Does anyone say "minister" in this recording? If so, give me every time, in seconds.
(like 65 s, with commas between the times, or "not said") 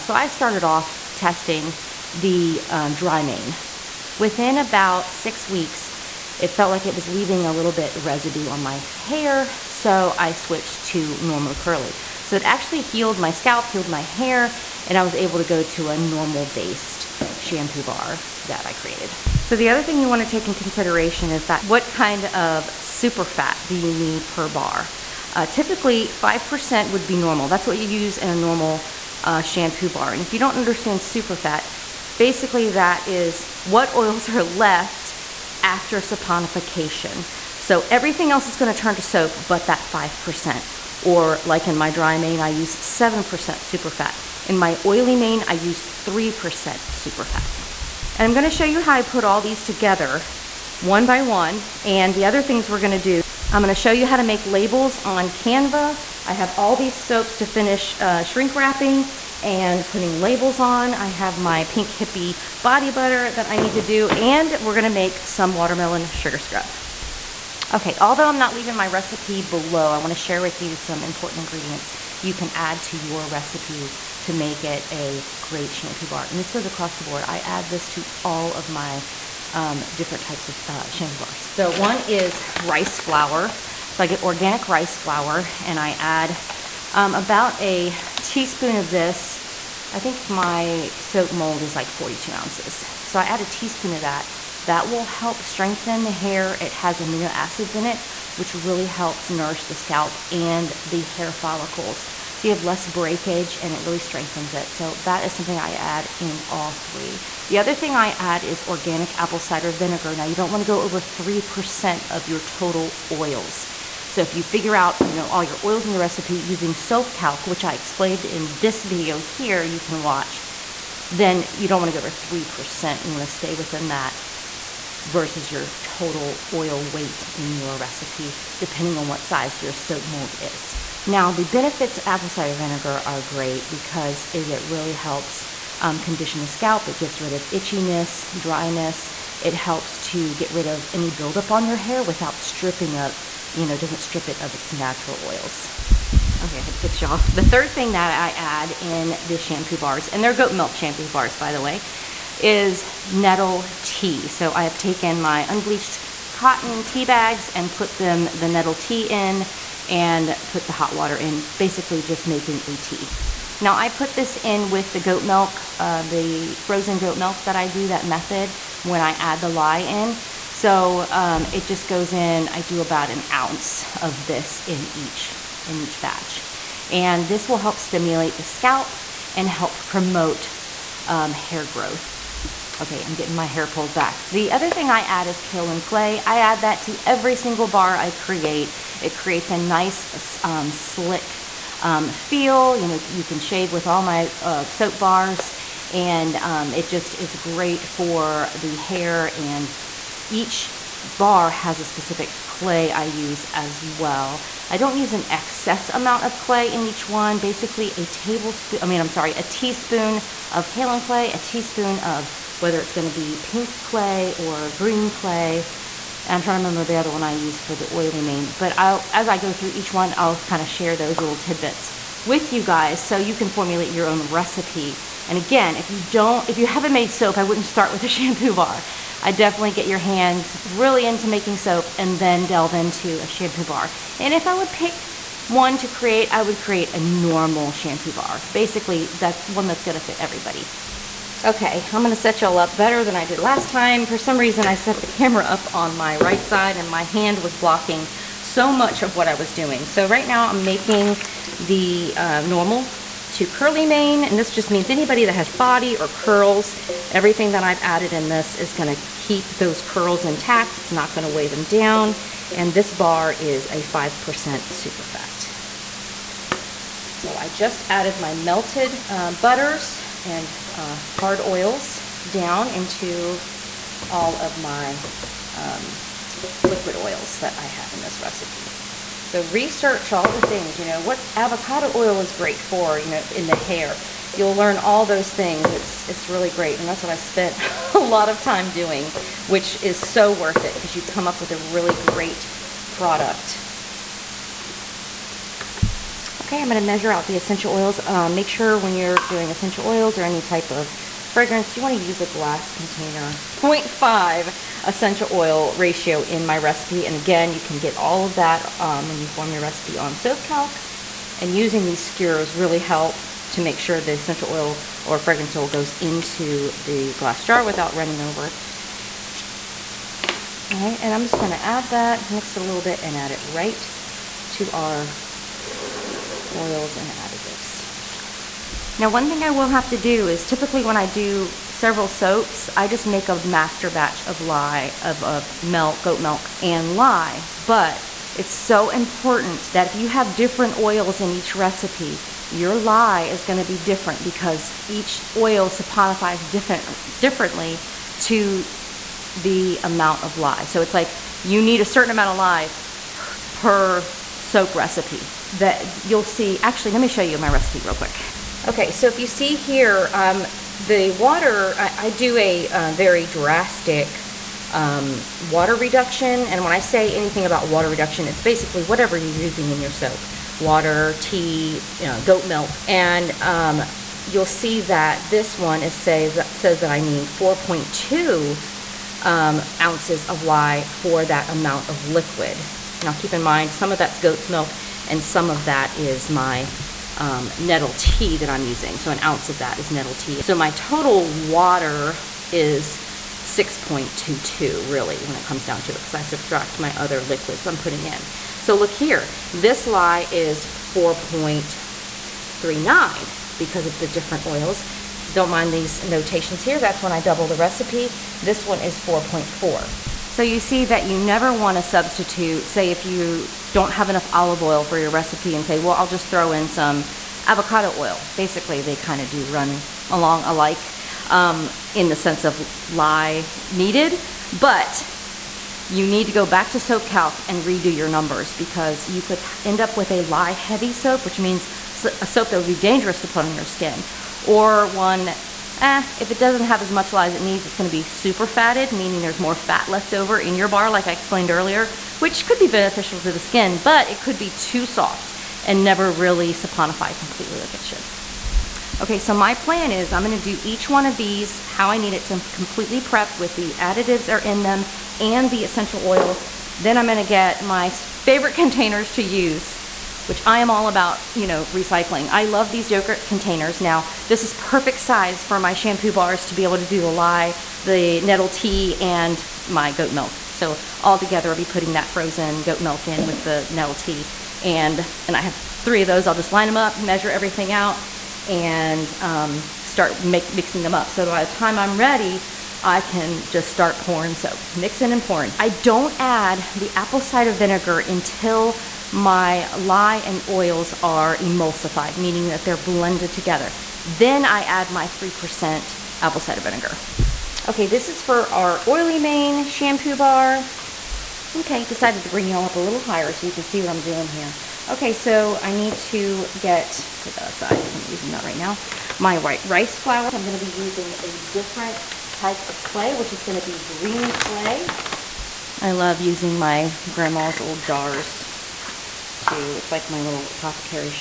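not said.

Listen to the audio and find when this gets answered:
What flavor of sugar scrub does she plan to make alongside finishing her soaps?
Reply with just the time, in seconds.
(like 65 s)
65 s.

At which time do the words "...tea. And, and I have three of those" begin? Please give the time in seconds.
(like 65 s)
473 s.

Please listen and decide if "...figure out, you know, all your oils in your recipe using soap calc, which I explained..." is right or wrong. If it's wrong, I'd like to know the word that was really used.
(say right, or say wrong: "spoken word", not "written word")
right.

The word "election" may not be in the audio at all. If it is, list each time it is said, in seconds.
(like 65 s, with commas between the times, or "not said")
not said.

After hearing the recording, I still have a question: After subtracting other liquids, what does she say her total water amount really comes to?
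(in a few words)
6.22.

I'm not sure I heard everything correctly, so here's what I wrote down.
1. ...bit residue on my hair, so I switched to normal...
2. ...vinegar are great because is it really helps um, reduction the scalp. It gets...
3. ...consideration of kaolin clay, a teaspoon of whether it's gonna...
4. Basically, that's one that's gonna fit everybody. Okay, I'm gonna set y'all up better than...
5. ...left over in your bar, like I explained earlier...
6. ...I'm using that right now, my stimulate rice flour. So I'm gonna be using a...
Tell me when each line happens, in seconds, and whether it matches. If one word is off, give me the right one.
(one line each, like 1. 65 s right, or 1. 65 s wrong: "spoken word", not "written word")
1. 7 s right
2. 132 s wrong: "condition", not "reduction"
3. 209 s wrong: "teaspoon", not "consideration"
4. 238 s right
5. 439 s right
6. 507 s wrong: "white", not "stimulate".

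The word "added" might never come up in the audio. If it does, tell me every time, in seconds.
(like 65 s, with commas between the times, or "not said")
257 s, 267 s.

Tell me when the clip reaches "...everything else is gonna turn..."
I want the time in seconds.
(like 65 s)
37 s.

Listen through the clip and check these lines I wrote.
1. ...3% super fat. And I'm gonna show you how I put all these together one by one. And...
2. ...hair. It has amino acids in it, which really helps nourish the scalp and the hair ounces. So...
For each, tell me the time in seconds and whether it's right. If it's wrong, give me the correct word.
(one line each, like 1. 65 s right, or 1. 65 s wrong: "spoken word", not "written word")
1. 46 s right
2. 96 s wrong: "follicles", not "ounces".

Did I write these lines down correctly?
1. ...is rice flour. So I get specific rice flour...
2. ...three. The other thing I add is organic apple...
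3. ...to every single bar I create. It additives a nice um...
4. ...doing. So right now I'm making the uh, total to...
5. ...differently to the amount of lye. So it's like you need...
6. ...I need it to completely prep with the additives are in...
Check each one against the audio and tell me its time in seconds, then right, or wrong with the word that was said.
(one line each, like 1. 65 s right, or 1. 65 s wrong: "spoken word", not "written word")
1. 82 s wrong: "organic", not "specific"
2. 106 s right
3. 186 s wrong: "creates", not "additives"
4. 249 s wrong: "normal", not "total"
5. 347 s right
6. 451 s right.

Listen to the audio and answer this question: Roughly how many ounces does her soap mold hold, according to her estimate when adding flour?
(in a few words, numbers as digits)
42 ounces.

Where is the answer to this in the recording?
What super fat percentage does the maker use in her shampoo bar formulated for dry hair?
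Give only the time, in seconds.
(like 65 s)
42 s.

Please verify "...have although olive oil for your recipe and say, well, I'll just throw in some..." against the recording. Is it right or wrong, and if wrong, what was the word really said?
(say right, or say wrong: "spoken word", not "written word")
wrong: "enough", not "although".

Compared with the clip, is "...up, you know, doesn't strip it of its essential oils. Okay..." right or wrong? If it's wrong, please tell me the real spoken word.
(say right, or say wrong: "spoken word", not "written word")
wrong: "natural", not "essential".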